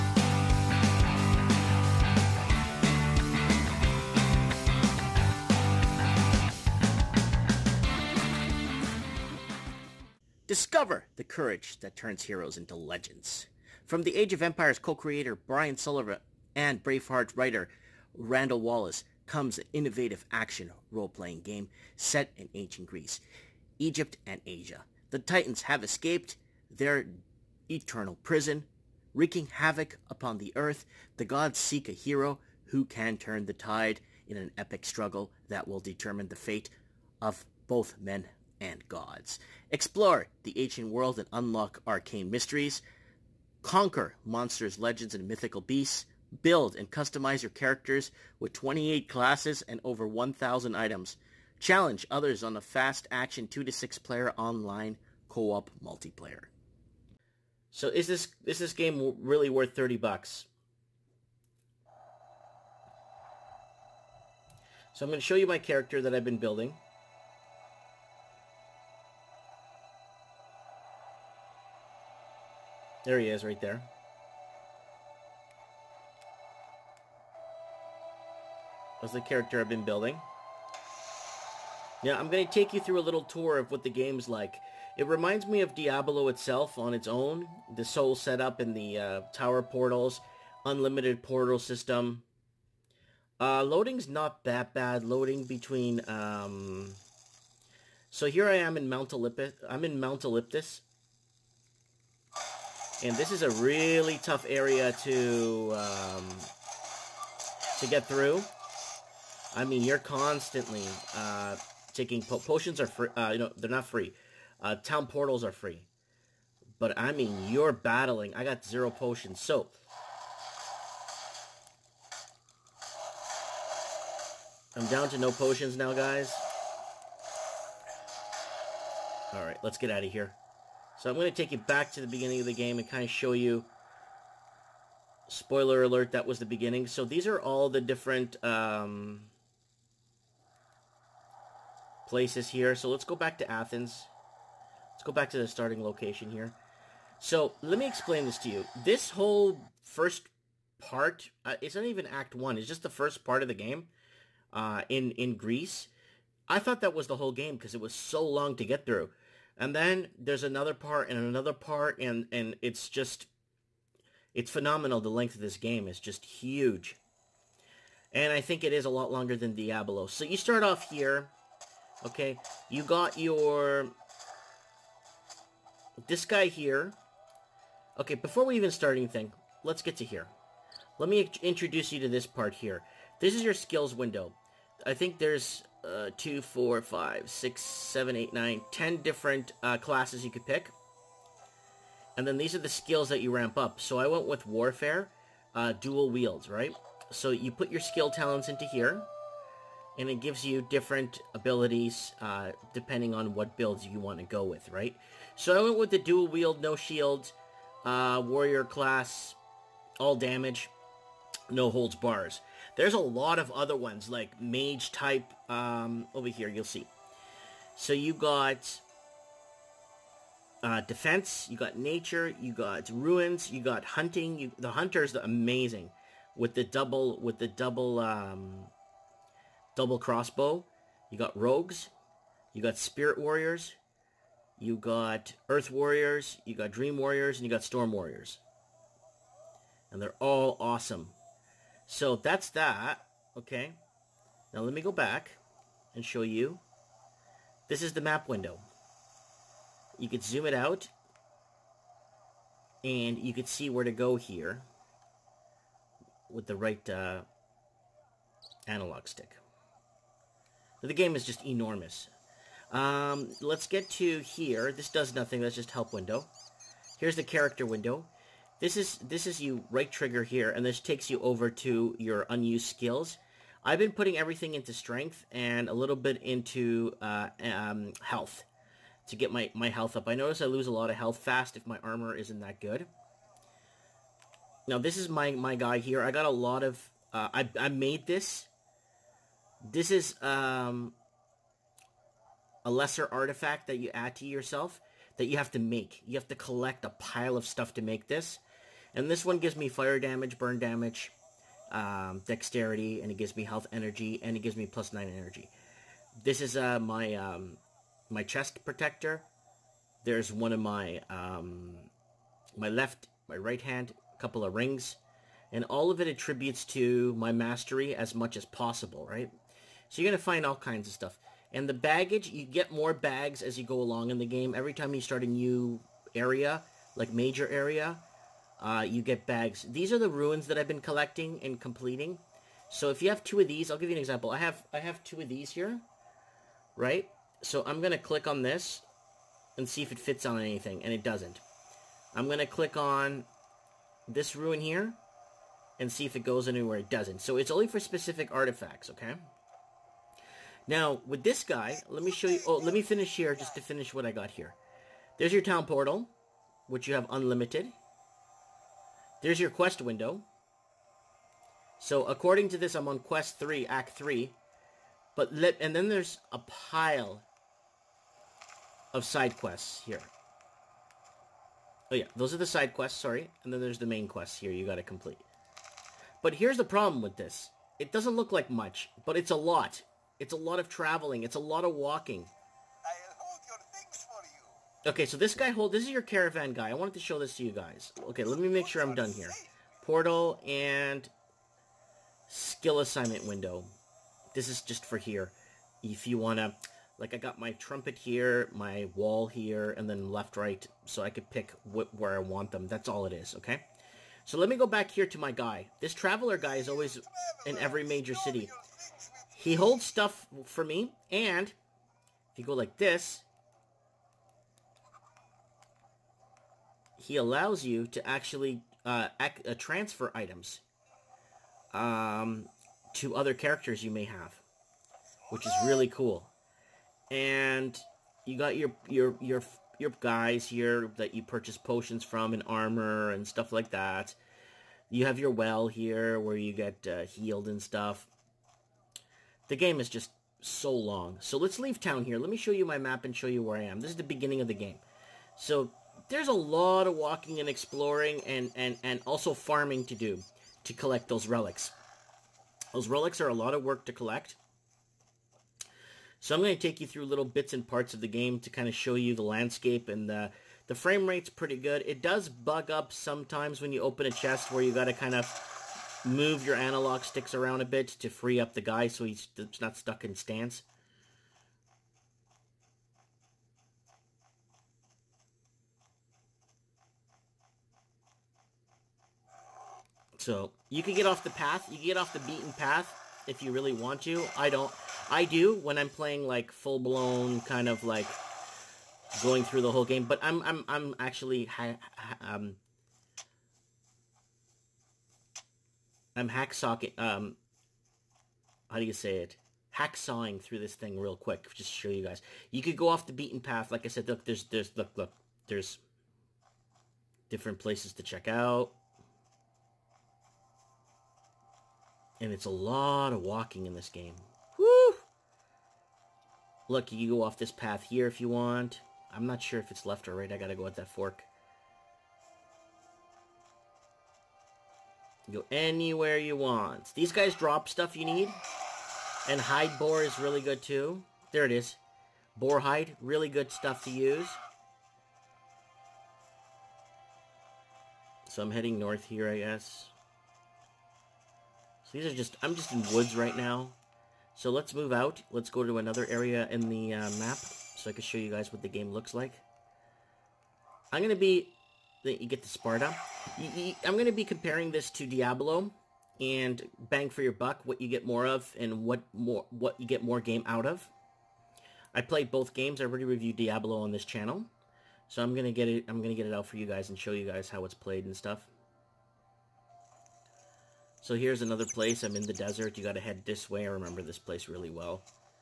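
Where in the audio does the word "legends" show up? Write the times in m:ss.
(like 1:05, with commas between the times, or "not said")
0:12, 0:44.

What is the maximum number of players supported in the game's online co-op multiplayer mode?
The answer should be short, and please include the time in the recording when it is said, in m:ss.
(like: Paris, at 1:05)
6, at 0:53.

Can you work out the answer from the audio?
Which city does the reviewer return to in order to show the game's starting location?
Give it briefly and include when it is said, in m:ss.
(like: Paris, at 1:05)
Athens, at 2:23.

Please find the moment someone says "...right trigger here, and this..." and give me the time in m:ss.
4:29.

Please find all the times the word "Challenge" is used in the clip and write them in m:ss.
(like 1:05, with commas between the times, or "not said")
0:51.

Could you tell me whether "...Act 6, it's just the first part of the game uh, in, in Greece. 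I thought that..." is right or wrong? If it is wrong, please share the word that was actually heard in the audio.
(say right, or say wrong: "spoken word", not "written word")
wrong: "1", not "6".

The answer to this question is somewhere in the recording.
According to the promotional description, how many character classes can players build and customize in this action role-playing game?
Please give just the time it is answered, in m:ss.
0:48.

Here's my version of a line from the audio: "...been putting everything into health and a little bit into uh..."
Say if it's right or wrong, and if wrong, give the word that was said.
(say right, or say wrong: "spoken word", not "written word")
wrong: "strength", not "health".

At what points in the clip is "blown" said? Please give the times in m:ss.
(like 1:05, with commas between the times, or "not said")
8:06.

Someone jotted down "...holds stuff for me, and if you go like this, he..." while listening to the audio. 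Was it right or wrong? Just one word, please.
right.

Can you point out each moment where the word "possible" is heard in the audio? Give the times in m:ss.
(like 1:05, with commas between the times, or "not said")
5:18.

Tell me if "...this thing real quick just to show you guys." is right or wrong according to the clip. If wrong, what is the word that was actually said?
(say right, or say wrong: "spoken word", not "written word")
right.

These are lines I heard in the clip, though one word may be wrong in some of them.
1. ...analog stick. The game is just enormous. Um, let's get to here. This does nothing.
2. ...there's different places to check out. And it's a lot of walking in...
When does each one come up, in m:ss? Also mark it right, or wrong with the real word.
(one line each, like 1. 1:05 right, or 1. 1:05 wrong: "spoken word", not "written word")
1. 4:18 right
2. 8:25 right.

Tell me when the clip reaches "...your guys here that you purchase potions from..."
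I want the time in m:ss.
7:09.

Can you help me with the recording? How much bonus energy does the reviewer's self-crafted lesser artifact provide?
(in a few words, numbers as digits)
plus 9.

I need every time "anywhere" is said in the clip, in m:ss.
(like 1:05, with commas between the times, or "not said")
5:46, 8:45.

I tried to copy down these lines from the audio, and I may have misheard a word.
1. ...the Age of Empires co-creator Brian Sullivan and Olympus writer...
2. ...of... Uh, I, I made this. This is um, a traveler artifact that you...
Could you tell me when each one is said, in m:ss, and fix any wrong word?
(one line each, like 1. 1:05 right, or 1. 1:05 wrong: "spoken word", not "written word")
1. 0:14 wrong: "Braveheart", not "Olympus"
2. 4:46 wrong: "lesser", not "traveler".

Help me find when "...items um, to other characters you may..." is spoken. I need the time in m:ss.
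7:00.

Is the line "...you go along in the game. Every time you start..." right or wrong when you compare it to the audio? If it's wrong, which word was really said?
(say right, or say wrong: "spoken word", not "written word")
right.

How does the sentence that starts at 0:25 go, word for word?
The Titans have escaped their eternal prison, wreaking havoc upon the earth.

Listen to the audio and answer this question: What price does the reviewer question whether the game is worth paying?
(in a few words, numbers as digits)
30 bucks.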